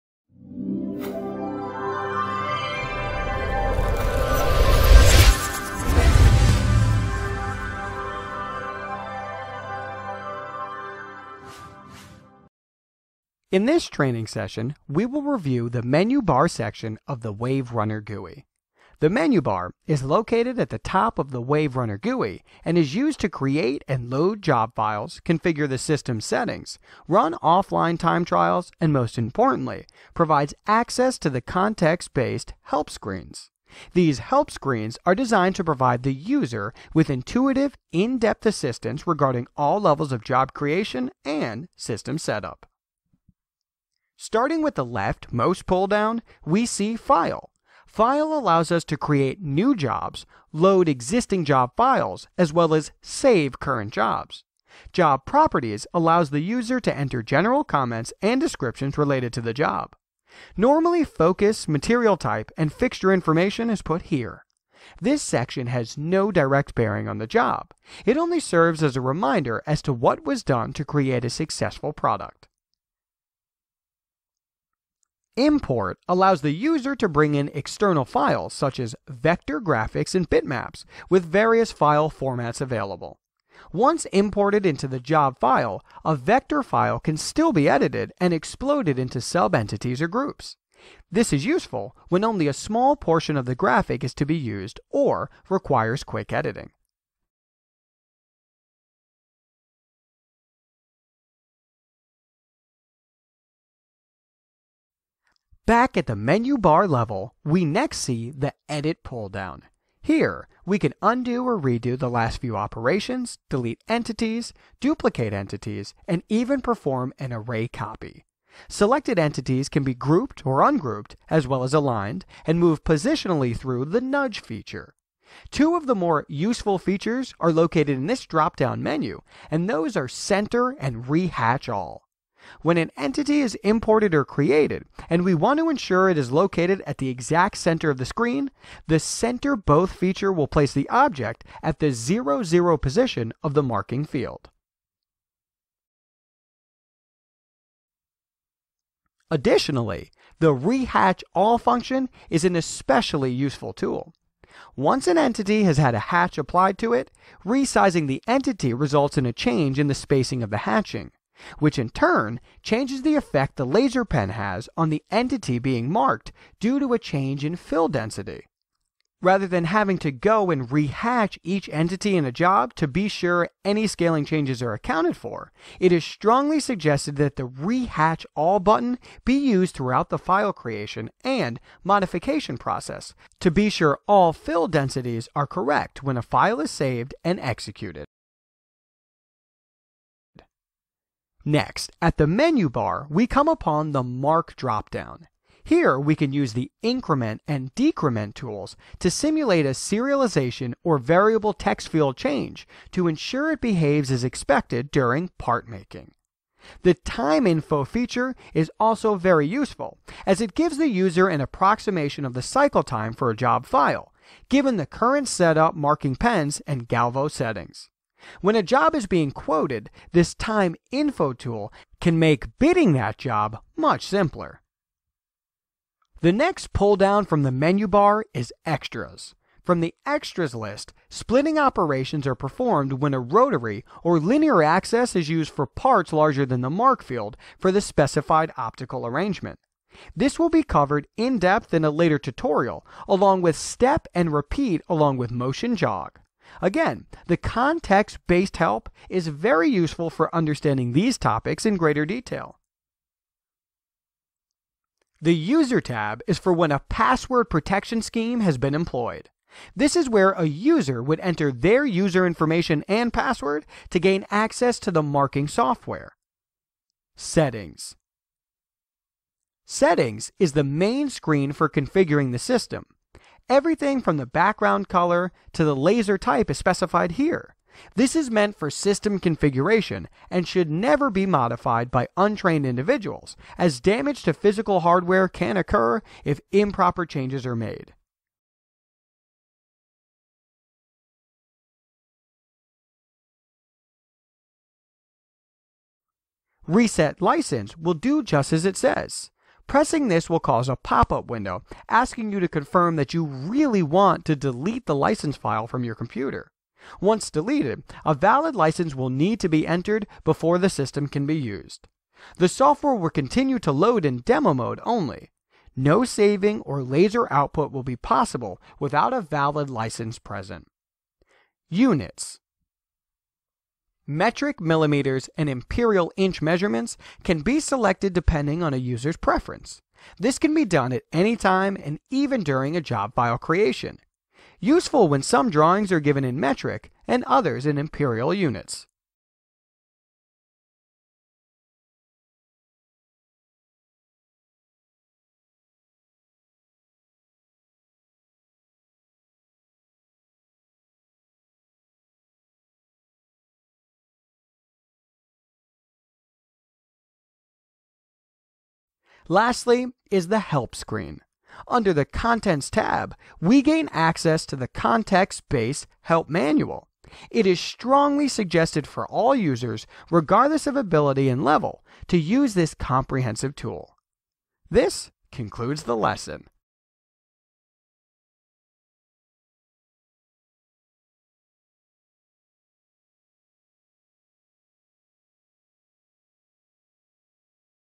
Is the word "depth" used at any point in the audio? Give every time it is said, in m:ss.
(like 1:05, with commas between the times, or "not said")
0:37, 4:01.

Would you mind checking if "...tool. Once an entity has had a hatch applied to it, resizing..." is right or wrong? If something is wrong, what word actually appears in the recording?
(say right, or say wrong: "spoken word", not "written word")
right.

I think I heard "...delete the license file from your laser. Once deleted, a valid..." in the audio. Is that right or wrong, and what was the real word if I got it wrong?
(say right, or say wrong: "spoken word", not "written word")
wrong: "computer", not "laser".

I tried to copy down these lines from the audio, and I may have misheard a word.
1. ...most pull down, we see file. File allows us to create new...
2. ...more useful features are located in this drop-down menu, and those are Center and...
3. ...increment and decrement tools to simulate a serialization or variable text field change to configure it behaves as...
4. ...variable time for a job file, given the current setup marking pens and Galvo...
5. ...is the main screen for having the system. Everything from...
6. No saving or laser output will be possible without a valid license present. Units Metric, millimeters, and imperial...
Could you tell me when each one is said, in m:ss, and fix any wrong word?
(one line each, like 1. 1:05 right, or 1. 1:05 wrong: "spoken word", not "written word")
1. 0:45 right
2. 2:05 right
3. 3:16 wrong: "ensure", not "configure"
4. 3:32 wrong: "cycle", not "variable"
5. 4:30 wrong: "configuring", not "having"
6. 5:15 right.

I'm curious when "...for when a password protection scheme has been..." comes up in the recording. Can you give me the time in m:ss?
4:16.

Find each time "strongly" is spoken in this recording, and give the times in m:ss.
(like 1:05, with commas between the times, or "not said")
2:56, 6:07.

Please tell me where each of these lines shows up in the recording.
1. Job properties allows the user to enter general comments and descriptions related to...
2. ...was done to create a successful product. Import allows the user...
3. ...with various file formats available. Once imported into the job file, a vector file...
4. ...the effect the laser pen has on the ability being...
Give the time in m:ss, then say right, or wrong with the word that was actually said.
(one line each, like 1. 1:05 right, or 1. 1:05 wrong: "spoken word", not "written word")
1. 0:54 right
2. 1:10 right
3. 1:21 right
4. 2:43 wrong: "entity", not "ability".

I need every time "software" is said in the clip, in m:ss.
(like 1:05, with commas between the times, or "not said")
4:25, 5:12.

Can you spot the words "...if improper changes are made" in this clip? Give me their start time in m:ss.
4:46.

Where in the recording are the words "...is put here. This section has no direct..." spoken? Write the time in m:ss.
1:03.